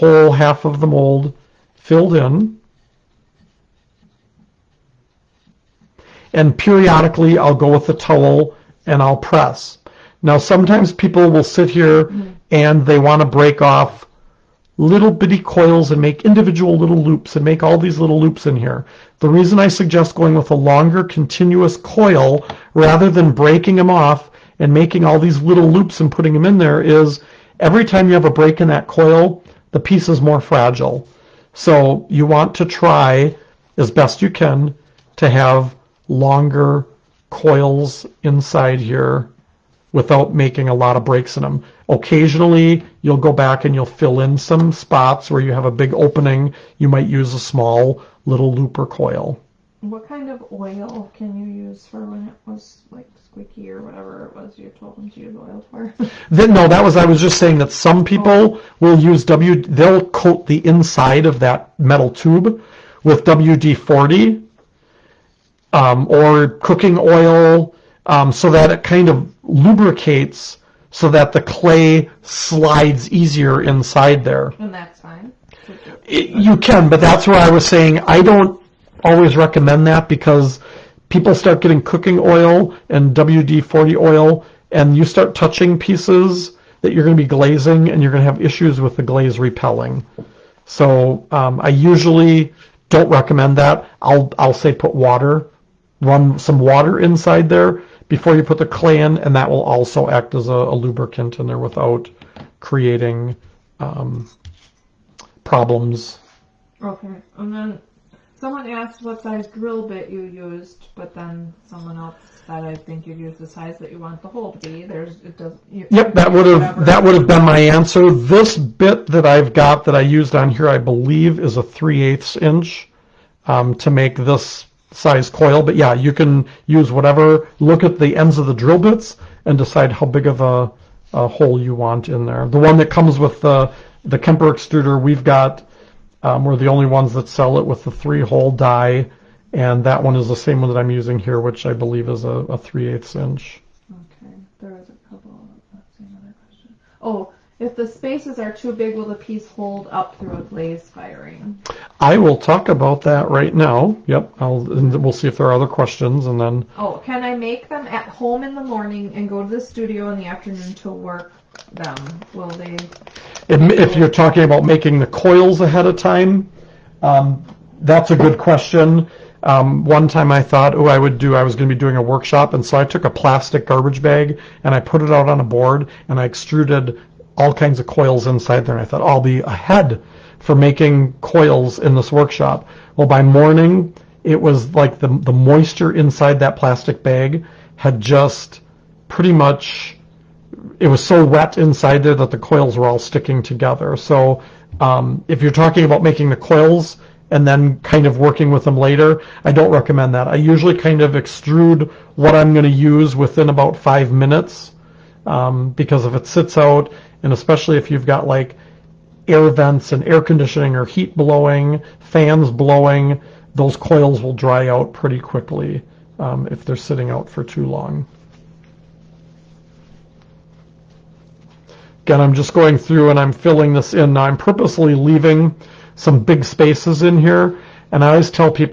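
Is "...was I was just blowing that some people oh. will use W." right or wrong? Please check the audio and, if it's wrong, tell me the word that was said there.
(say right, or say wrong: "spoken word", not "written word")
wrong: "saying", not "blowing".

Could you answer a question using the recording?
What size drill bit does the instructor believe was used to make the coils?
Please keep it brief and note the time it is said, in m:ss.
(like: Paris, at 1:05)
3/8 inch, at 2:01.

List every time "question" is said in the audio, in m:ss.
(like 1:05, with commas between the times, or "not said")
2:26, 2:35, 2:48.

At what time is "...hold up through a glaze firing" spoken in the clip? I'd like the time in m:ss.
2:29.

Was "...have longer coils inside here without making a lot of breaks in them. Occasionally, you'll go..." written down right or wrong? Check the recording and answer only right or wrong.
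right.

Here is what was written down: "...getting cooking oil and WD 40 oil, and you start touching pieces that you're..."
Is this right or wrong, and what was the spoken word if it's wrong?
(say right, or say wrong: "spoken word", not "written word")
right.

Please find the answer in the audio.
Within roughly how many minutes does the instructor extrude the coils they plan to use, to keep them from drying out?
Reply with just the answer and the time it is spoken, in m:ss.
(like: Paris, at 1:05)
5 minutes, at 3:23.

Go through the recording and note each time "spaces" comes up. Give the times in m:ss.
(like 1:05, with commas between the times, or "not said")
2:27, 3:46.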